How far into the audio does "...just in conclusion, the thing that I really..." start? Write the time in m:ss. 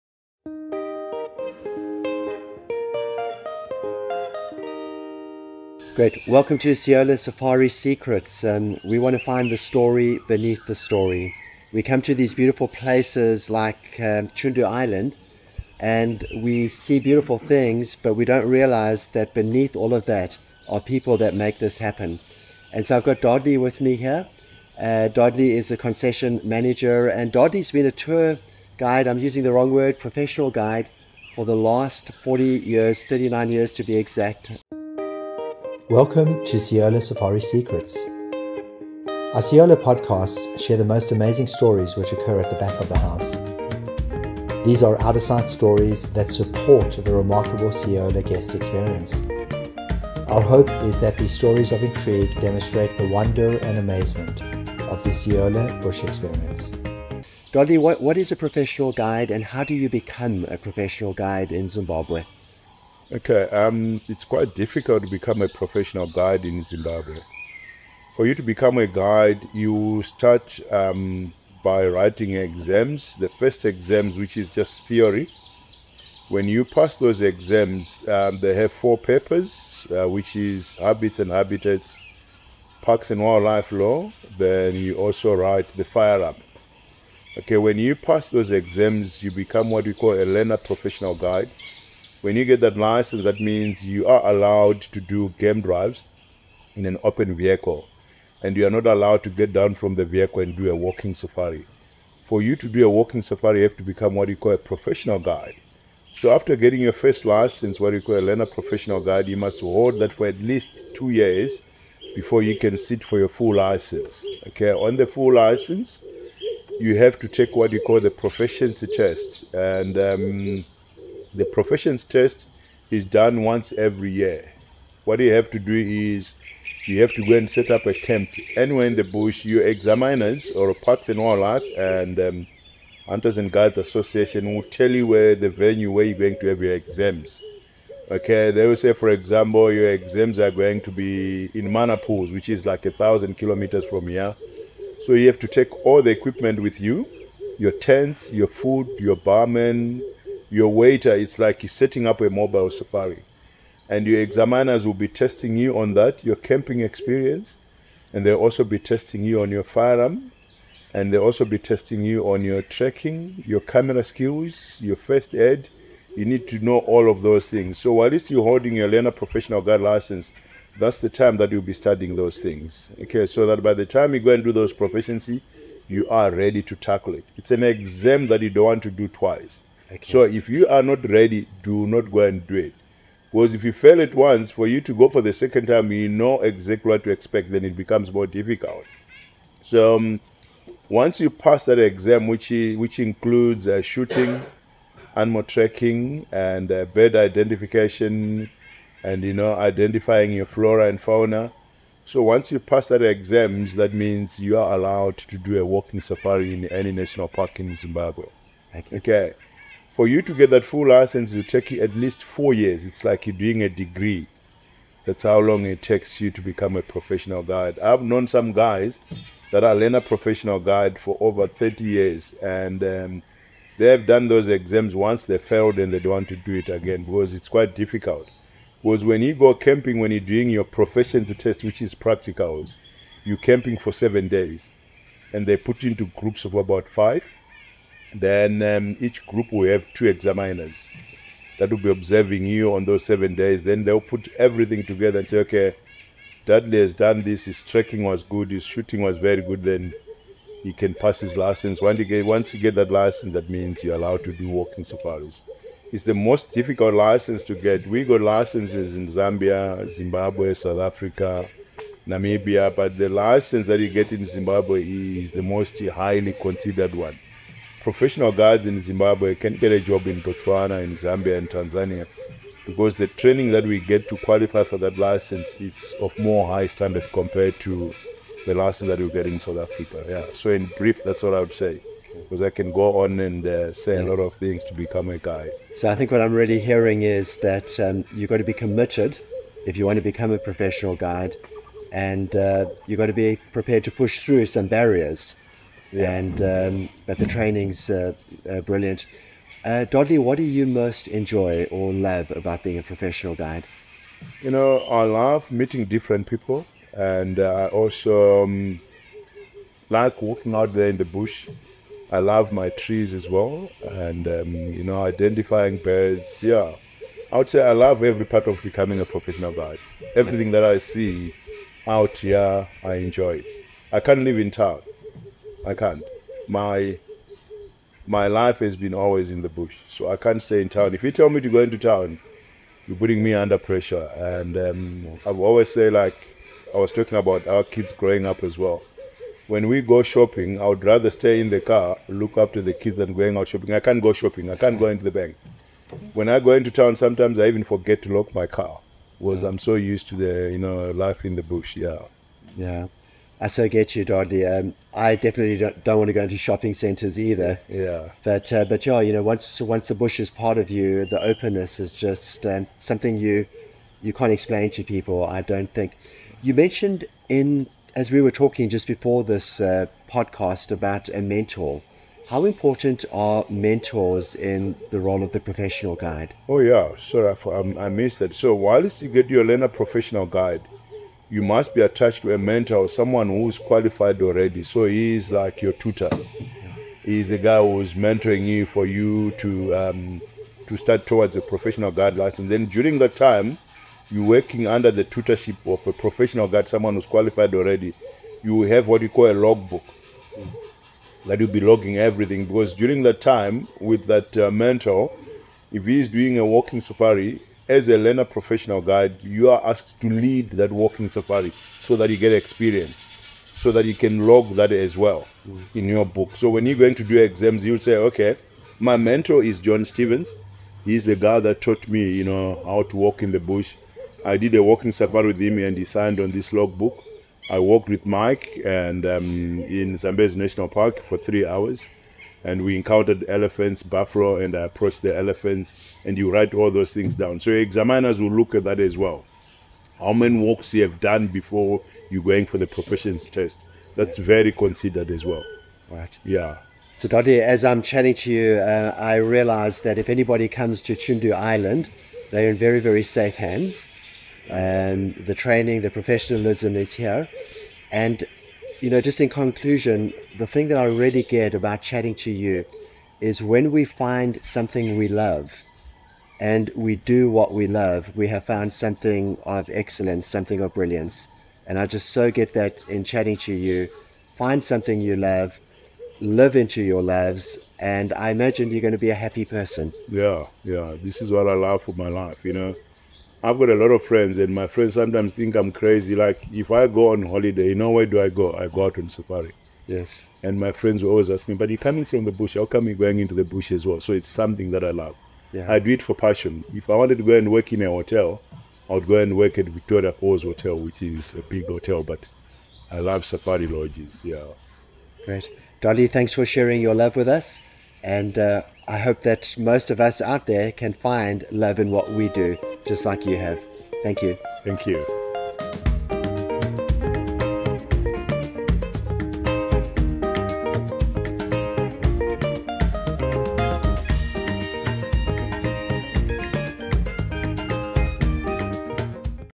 7:38.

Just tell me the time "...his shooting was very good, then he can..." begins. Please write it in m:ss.
4:08.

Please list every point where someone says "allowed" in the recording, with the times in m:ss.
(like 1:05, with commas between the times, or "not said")
1:34, 1:38, 3:24, 4:13.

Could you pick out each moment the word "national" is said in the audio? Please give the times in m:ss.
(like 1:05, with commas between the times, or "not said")
3:26, 7:10.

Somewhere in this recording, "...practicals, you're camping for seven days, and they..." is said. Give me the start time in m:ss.
3:51.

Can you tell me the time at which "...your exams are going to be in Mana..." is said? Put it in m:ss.
2:19.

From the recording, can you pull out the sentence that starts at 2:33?
And your examiners will be testing you on that, your camping experience.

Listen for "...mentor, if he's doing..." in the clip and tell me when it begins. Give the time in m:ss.
6:44.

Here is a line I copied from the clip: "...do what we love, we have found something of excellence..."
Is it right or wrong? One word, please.
right.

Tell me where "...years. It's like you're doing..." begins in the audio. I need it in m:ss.
3:32.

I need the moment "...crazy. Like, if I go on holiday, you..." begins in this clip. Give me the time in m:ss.
8:05.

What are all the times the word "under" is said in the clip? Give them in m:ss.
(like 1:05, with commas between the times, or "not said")
5:33, 6:34.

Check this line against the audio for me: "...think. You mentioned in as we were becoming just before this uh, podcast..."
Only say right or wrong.
wrong.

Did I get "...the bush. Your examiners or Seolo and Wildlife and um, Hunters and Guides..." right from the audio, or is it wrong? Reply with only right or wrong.
wrong.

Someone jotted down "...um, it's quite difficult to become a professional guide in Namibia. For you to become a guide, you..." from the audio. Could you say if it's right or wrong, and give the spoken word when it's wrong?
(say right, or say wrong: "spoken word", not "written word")
wrong: "Zimbabwe", not "Namibia".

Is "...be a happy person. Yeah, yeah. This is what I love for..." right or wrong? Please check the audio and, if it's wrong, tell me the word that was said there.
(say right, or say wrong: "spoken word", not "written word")
right.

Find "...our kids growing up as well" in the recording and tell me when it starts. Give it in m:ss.
5:37.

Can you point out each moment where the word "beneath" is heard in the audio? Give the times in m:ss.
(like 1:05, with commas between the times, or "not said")
0:10, 0:19.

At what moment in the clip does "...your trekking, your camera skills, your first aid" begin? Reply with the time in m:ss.
2:42.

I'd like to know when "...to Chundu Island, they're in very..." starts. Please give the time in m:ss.
7:30.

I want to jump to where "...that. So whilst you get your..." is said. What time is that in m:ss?
6:18.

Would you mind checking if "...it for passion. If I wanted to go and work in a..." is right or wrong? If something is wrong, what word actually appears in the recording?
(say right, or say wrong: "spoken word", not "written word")
right.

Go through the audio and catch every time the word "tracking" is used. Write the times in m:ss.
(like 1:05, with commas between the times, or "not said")
3:15.